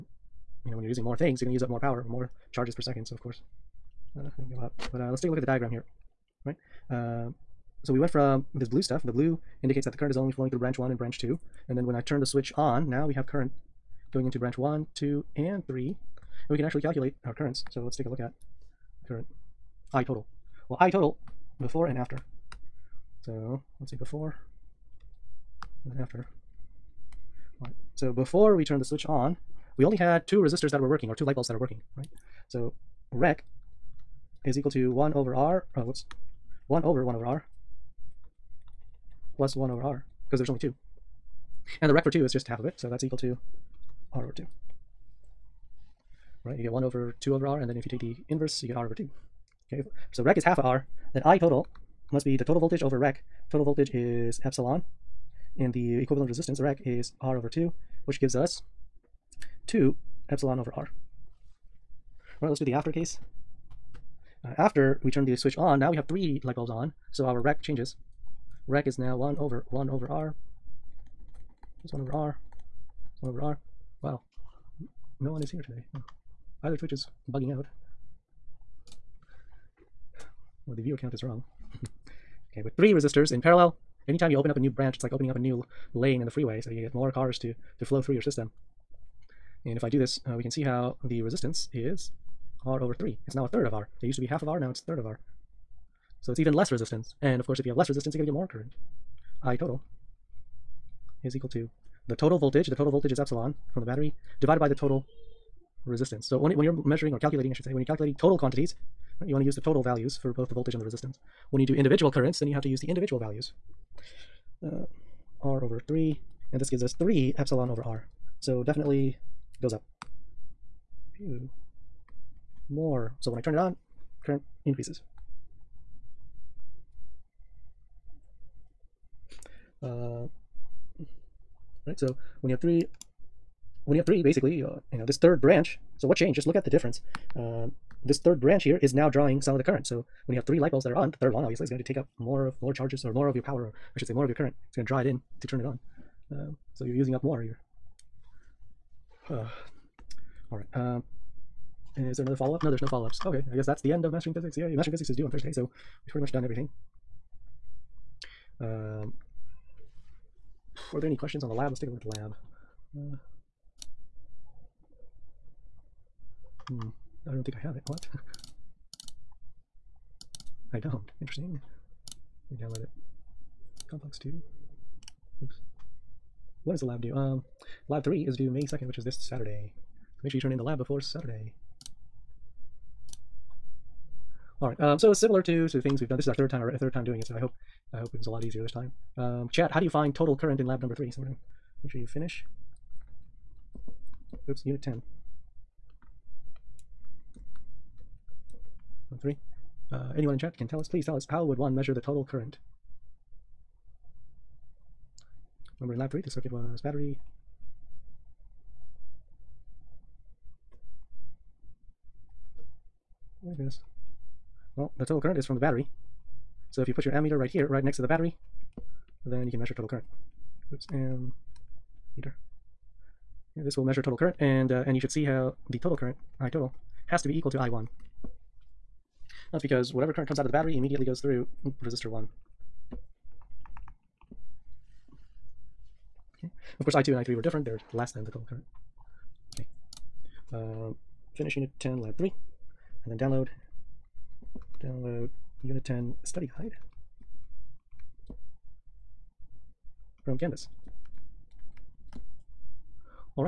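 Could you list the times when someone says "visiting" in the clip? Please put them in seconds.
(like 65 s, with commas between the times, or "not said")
not said.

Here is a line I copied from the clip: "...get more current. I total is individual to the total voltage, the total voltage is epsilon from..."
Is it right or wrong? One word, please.
wrong.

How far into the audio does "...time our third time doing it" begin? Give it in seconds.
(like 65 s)
186 s.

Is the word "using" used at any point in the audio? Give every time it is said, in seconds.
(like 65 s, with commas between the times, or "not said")
0 s, 146 s.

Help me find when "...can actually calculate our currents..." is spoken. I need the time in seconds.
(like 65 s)
16 s.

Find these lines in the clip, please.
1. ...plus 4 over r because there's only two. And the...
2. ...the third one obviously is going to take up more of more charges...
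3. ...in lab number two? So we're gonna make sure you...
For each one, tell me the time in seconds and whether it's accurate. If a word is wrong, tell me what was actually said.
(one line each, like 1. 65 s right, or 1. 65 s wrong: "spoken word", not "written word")
1. 39 s wrong: "1", not "4"
2. 141 s right
3. 190 s wrong: "three", not "two".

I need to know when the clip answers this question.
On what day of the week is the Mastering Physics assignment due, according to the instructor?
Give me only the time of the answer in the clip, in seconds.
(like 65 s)
155 s.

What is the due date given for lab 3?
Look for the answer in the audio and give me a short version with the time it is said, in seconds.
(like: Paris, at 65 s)
May 2nd, at 178 s.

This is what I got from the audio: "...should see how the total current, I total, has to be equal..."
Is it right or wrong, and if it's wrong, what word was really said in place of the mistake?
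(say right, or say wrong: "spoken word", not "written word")
right.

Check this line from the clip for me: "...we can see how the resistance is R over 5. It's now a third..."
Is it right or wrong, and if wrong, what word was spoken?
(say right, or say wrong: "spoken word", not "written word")
wrong: "3", not "5".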